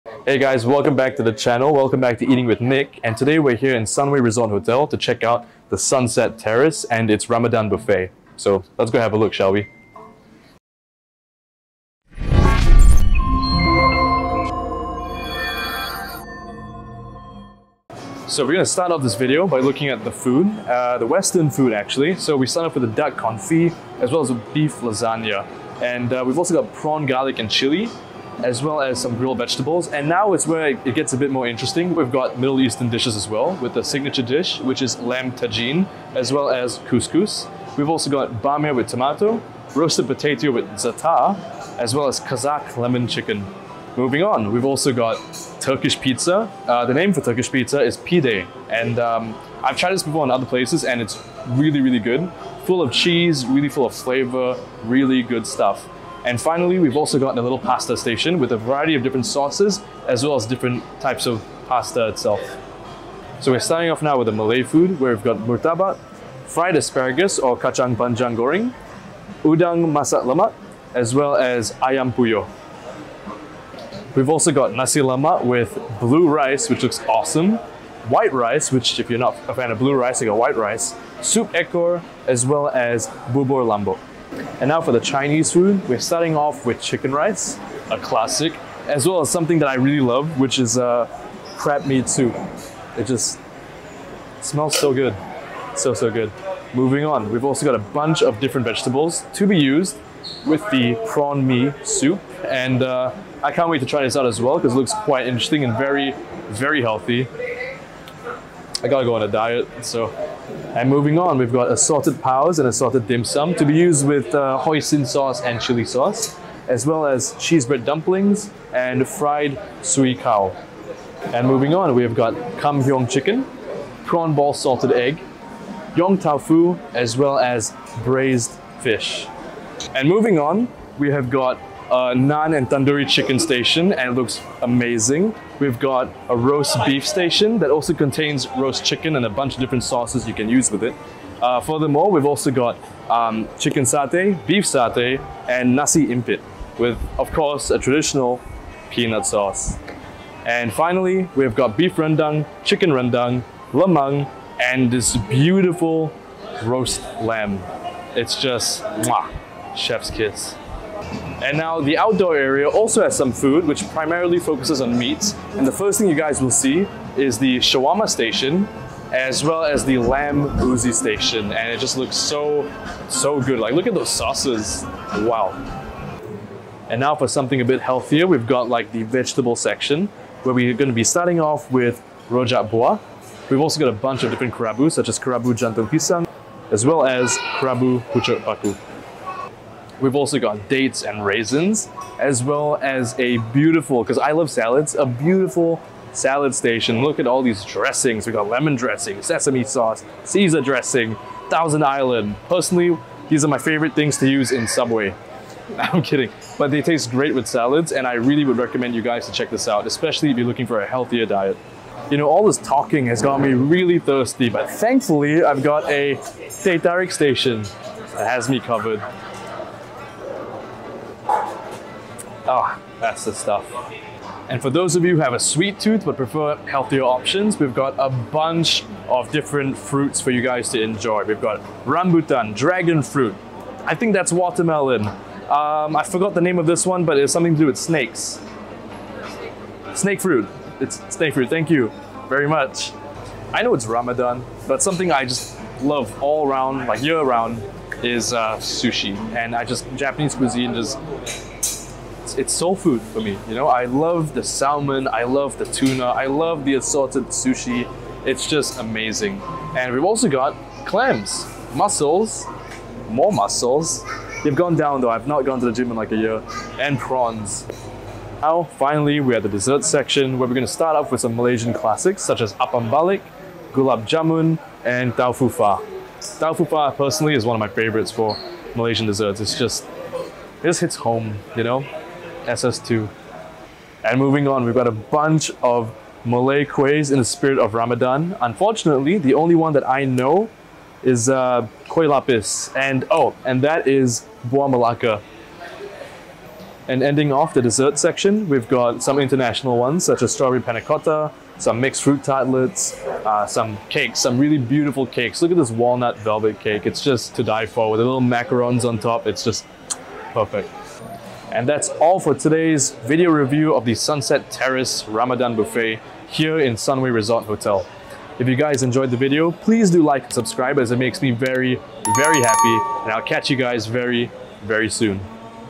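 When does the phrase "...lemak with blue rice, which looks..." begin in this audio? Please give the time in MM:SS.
01:14.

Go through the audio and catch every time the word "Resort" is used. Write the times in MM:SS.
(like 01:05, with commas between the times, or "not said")
00:04, 05:17.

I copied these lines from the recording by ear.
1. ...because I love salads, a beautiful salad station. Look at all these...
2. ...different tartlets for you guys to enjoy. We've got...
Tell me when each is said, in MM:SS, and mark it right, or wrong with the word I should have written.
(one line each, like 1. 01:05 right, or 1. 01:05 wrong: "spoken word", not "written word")
1. 03:14 right
2. 03:49 wrong: "fruits", not "tartlets".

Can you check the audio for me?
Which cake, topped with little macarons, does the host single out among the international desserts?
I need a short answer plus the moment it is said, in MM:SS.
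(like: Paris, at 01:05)
Walnut velvet cake, at 05:05.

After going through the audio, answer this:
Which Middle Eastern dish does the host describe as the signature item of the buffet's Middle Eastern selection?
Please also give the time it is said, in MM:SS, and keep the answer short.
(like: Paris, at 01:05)
Lamb tagine, at 00:34.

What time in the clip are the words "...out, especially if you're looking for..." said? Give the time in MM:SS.
03:29.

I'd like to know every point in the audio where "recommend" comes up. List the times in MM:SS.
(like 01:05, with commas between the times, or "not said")
03:28.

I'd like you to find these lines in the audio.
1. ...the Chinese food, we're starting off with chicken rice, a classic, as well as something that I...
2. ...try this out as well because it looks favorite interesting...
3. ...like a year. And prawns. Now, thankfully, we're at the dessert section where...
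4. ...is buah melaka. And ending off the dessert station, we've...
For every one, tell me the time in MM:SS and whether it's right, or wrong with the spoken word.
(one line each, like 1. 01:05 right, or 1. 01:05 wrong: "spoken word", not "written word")
1. 01:24 right
2. 01:43 wrong: "quite", not "favorite"
3. 04:25 wrong: "finally", not "thankfully"
4. 04:53 wrong: "section", not "station".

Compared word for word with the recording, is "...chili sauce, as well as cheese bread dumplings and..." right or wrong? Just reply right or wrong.
right.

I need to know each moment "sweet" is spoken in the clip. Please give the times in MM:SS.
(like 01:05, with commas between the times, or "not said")
03:45.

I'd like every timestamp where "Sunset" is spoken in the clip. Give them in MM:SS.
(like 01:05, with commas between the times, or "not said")
00:05, 05:13.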